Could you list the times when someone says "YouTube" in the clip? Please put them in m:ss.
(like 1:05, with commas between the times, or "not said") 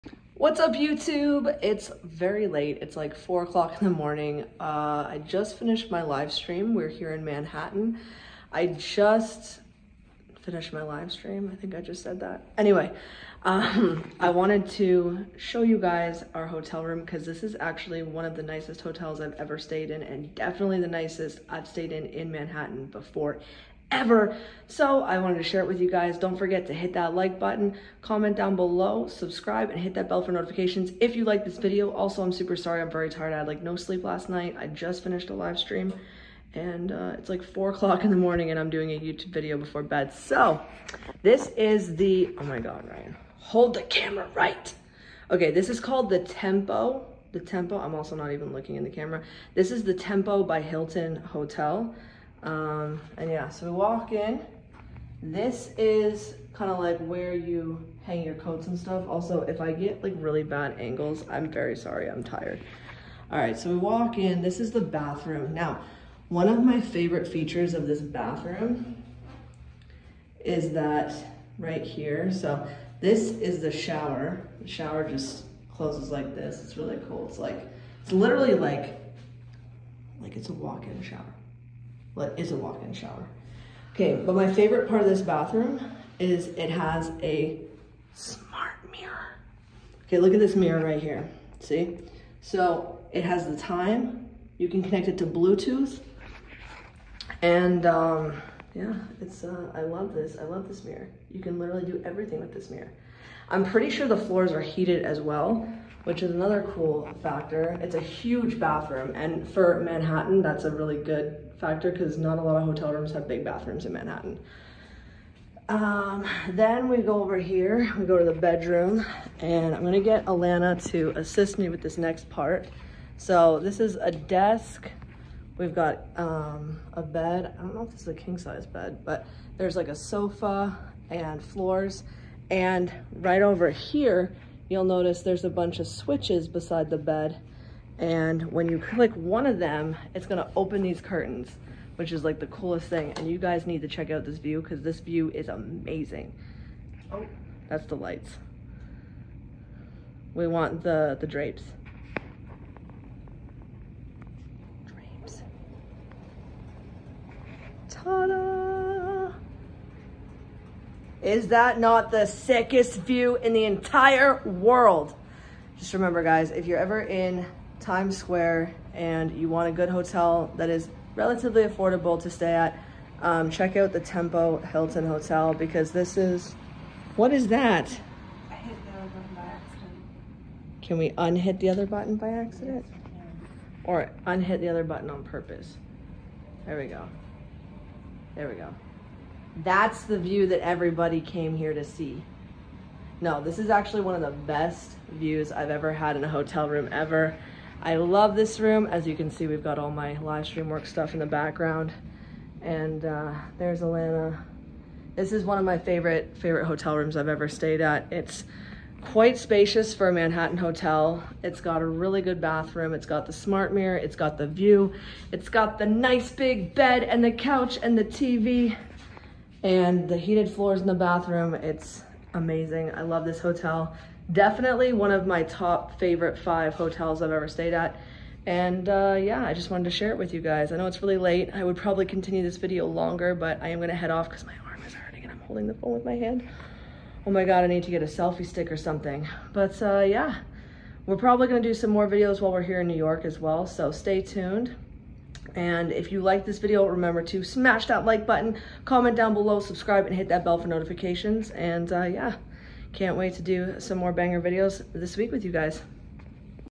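0:00, 0:38.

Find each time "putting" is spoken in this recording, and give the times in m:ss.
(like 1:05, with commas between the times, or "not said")
not said.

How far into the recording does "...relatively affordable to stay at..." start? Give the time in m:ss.
2:51.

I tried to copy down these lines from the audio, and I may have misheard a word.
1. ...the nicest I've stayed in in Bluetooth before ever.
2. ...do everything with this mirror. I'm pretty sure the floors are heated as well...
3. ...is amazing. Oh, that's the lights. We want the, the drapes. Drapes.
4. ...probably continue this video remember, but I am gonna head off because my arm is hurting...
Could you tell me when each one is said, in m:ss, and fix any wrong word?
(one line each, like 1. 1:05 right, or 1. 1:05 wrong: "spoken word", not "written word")
1. 0:20 wrong: "Manhattan", not "Bluetooth"
2. 1:41 right
3. 2:25 right
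4. 3:51 wrong: "longer", not "remember".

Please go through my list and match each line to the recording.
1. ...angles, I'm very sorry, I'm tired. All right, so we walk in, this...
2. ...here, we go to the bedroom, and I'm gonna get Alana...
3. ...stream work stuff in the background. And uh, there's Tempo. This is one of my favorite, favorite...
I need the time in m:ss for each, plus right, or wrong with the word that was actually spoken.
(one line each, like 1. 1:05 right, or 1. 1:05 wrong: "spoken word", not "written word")
1. 1:00 right
2. 1:57 right
3. 3:20 wrong: "Alana", not "Tempo".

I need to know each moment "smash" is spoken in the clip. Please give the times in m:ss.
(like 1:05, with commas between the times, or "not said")
4:07.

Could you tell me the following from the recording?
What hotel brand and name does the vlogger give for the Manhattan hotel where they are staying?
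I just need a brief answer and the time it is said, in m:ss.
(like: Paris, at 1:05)
Tempo by Hilton, at 0:49.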